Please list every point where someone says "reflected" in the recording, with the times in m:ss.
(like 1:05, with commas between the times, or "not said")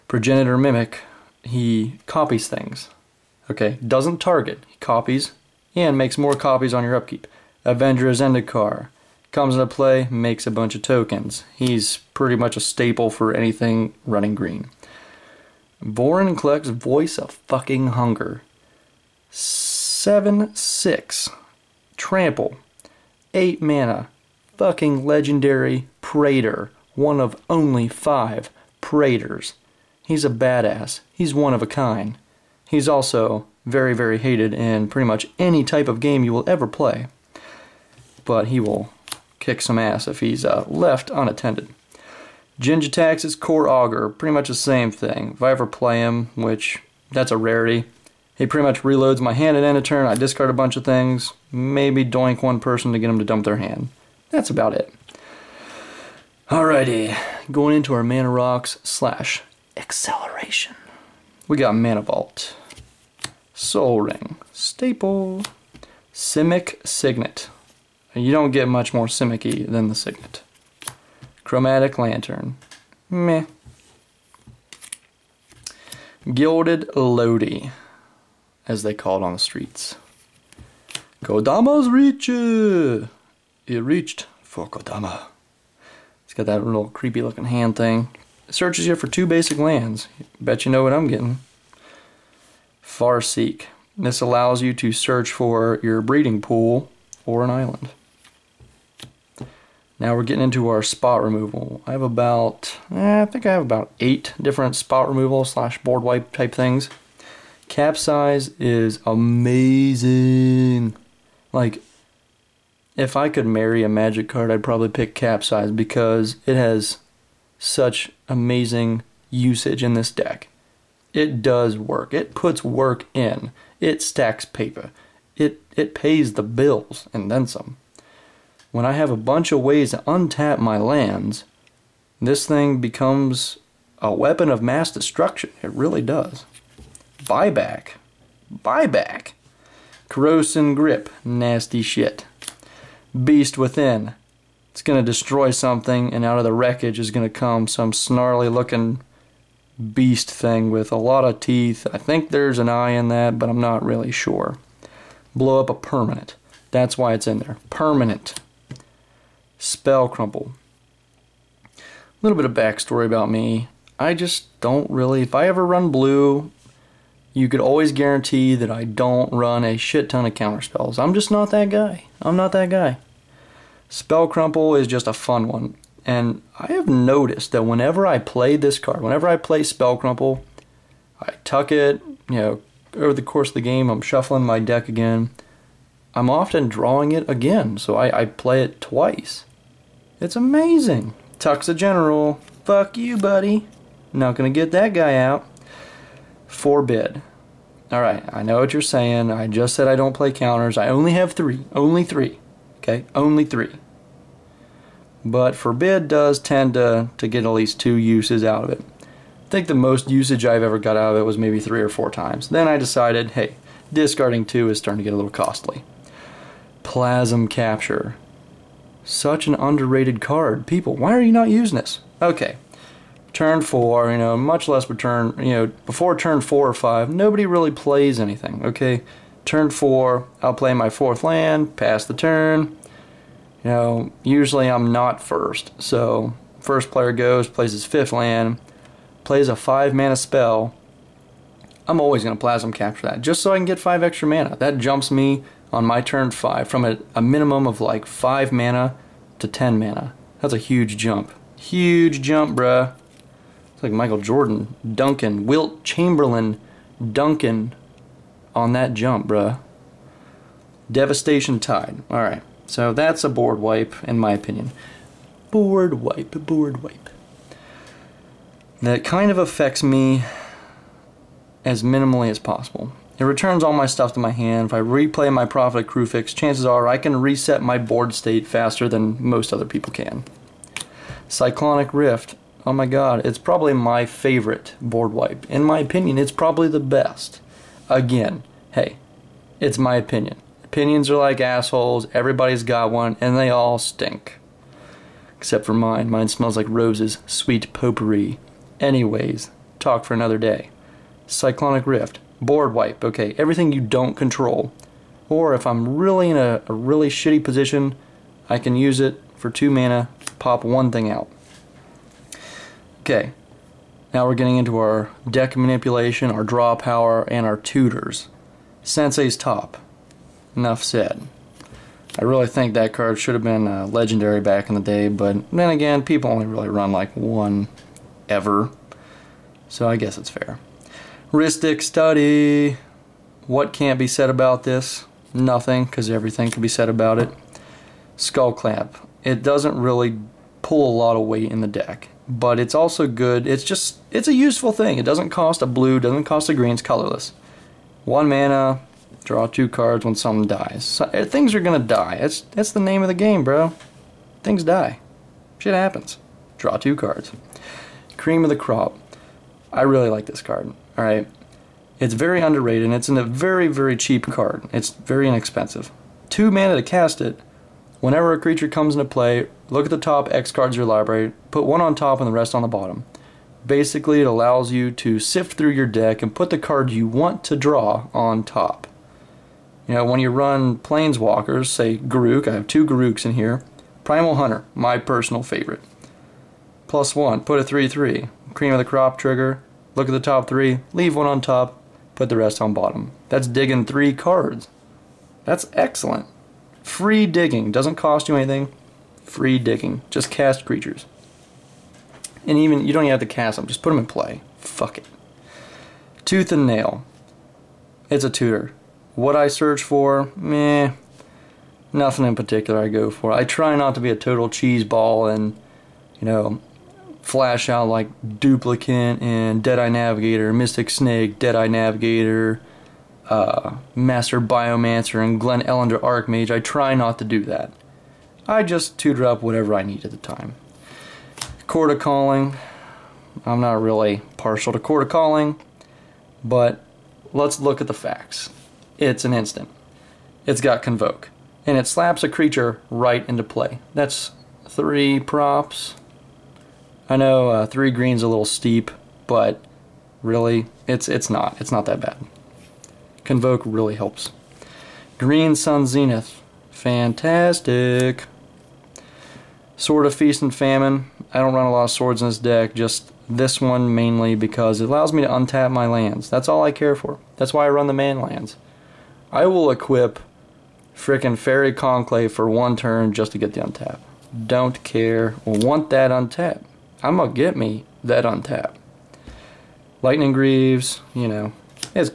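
not said.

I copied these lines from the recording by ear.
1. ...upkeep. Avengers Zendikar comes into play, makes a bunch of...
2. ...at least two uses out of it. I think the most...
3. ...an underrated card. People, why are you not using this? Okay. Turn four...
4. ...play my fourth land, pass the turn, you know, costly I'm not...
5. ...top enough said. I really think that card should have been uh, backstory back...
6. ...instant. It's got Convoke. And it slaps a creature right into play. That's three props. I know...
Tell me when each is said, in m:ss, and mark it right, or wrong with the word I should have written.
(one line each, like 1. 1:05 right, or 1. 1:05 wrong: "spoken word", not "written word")
1. 0:06 right
2. 3:27 right
3. 3:39 right
4. 3:50 wrong: "usually", not "costly"
5. 5:19 wrong: "legendary", not "backstory"
6. 7:19 right.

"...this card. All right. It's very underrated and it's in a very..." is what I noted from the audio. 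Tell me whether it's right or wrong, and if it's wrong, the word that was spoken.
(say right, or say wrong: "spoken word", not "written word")
right.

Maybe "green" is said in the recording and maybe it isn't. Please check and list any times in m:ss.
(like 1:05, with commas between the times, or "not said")
0:14, 5:46, 7:27, 7:35.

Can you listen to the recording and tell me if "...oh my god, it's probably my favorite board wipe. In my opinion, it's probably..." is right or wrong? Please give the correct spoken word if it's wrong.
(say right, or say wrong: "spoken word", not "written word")
right.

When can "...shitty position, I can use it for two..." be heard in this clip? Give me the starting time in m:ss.
5:07.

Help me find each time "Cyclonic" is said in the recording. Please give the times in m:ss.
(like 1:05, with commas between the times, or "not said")
4:41, 5:01.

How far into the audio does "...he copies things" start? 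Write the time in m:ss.
0:01.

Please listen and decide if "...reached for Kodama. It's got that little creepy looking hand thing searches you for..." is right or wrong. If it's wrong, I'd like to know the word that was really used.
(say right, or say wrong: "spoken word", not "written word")
right.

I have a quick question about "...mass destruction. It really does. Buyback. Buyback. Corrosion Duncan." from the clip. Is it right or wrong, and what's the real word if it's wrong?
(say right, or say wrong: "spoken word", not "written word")
wrong: "Grip", not "Duncan".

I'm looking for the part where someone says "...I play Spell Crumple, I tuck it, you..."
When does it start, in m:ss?
2:59.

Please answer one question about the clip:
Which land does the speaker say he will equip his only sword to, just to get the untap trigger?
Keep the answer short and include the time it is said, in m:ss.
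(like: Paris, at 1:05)
Faerie Conclave, at 7:51.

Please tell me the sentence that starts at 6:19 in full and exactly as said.
You know, when you run Planeswalkers, say Garruk, I have two Garruks in here.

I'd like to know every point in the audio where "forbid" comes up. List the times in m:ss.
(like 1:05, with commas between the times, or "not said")
3:16, 3:25.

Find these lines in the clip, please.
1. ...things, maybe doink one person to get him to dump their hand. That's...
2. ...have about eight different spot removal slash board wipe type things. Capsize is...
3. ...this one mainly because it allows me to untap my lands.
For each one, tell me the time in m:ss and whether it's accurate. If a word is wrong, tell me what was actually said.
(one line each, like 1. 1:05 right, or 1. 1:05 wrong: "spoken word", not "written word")
1. 0:50 right
2. 1:43 right
3. 7:43 right.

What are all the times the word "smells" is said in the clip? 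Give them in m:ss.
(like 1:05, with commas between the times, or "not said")
4:56.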